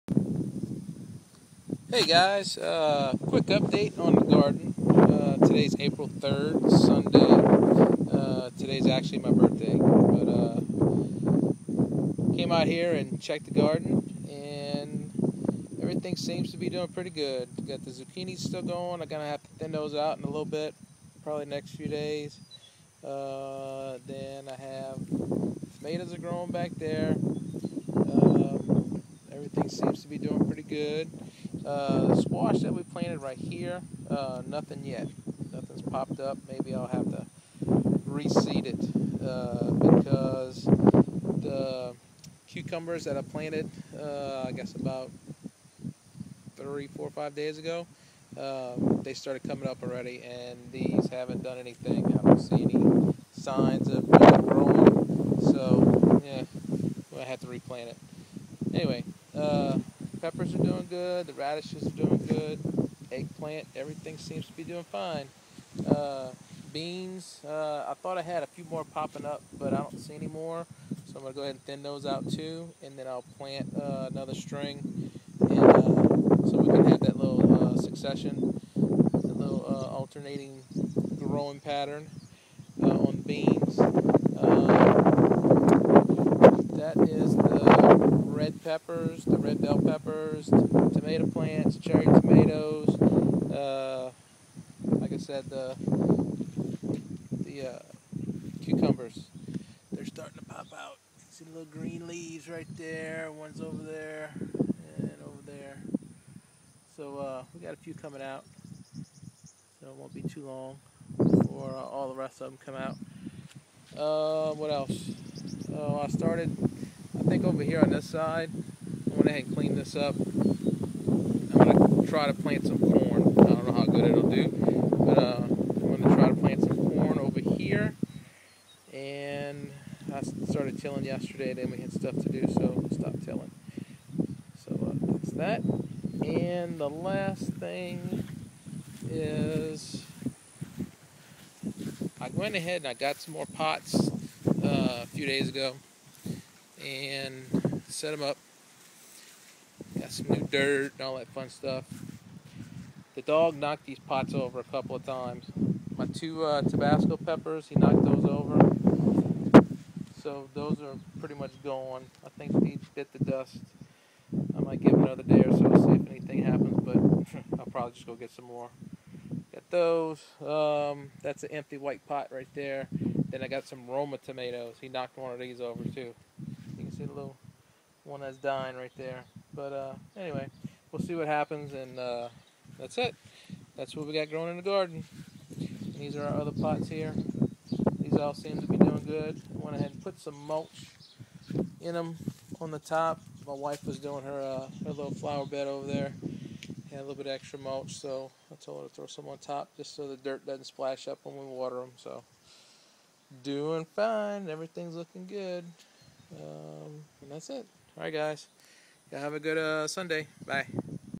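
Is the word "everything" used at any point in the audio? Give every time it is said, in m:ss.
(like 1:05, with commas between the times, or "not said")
0:15, 0:29, 1:03, 3:24.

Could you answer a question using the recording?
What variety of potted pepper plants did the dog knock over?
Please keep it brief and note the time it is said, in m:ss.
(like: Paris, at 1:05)
Tabasco, at 2:36.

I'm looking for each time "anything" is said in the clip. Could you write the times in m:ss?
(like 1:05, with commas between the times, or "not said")
0:51, 2:46.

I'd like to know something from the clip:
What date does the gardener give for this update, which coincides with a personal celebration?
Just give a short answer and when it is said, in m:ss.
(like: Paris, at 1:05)
April 3rd, at 0:05.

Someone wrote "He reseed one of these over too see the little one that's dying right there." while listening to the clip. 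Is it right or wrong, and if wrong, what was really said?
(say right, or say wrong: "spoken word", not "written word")
wrong: "knocked", not "reseed".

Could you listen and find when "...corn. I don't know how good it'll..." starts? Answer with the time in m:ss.
2:02.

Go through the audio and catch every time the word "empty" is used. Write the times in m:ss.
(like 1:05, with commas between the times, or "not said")
2:51.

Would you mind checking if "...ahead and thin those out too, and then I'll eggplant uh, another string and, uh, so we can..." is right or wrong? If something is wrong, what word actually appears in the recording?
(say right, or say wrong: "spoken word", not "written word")
wrong: "plant", not "eggplant".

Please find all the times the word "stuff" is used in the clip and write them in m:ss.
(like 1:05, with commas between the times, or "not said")
2:11, 2:31.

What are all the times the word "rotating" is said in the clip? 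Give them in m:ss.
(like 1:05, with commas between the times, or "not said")
not said.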